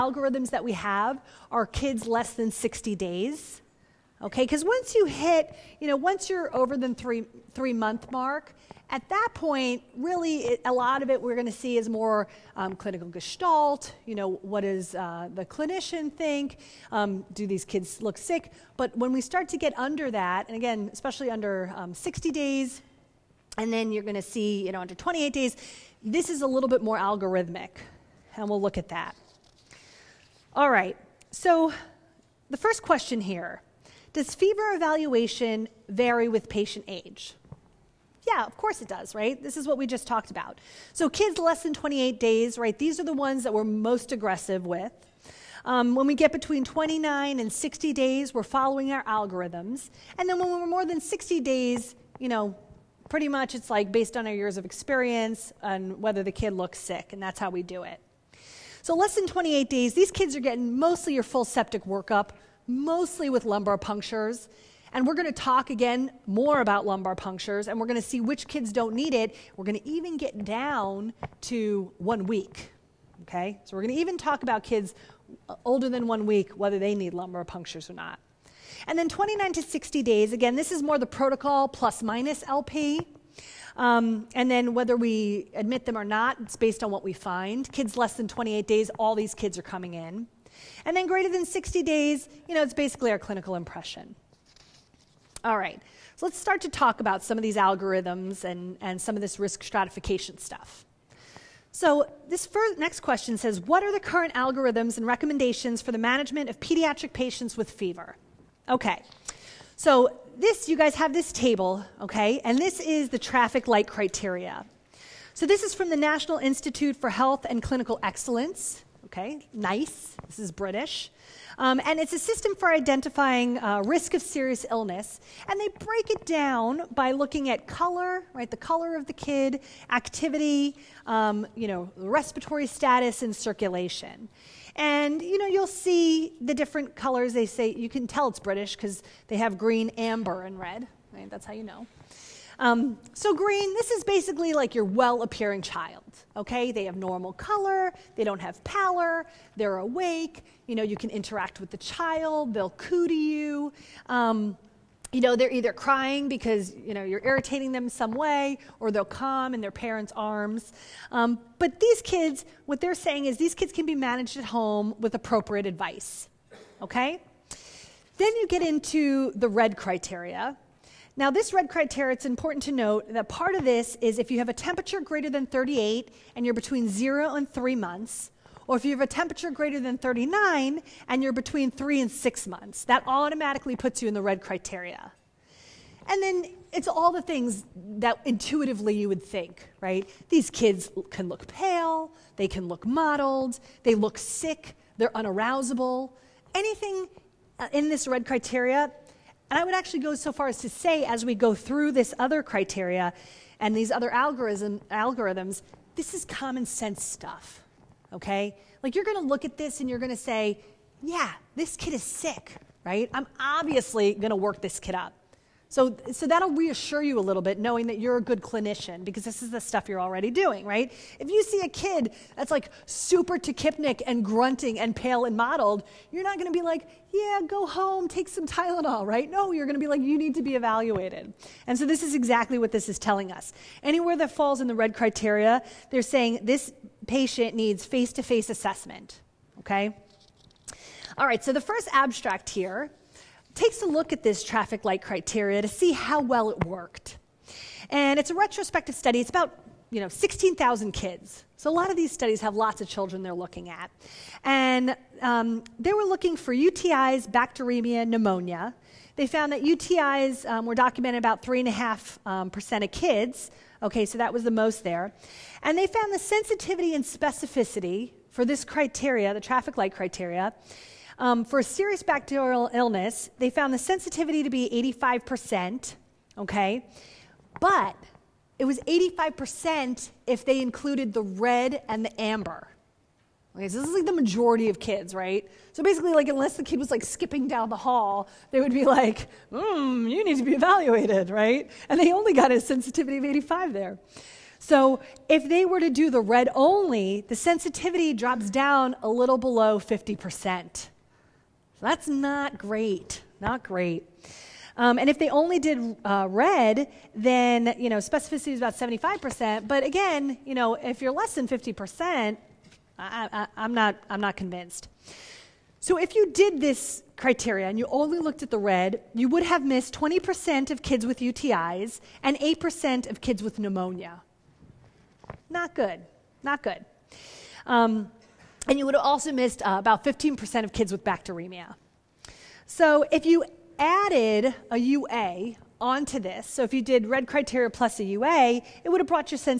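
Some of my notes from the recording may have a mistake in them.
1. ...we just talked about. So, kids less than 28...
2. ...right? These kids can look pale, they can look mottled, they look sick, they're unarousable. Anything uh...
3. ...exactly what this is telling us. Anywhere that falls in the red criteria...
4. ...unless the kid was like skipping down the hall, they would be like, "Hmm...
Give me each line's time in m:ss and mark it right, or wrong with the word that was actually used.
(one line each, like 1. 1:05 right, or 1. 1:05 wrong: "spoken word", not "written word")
1. 0:39 right
2. 3:09 right
3. 3:52 right
4. 4:46 right.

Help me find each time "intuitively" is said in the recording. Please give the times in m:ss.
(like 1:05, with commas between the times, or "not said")
3:08.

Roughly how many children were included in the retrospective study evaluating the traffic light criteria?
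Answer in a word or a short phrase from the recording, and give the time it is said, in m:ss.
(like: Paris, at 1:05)
16,000, at 4:10.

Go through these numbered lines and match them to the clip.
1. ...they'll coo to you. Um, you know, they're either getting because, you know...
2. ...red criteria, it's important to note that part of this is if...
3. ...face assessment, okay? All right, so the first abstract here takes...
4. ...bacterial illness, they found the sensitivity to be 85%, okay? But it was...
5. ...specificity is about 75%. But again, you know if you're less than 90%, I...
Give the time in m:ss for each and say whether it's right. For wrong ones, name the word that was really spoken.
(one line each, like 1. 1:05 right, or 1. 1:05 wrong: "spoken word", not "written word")
1. 2:32 wrong: "crying", not "getting"
2. 2:51 right
3. 3:58 right
4. 4:32 right
5. 5:07 wrong: "50", not "90".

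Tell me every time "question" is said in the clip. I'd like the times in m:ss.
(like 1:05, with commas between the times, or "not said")
0:32, 1:42.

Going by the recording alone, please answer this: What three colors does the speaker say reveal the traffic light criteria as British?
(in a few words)
Green, amber, and red.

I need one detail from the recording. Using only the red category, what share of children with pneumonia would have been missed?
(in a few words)
8%.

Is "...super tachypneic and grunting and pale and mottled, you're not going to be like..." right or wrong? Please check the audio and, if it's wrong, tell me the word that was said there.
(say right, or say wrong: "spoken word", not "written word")
right.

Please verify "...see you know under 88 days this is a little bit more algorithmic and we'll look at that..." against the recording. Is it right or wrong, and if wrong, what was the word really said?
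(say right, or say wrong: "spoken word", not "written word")
wrong: "28", not "88".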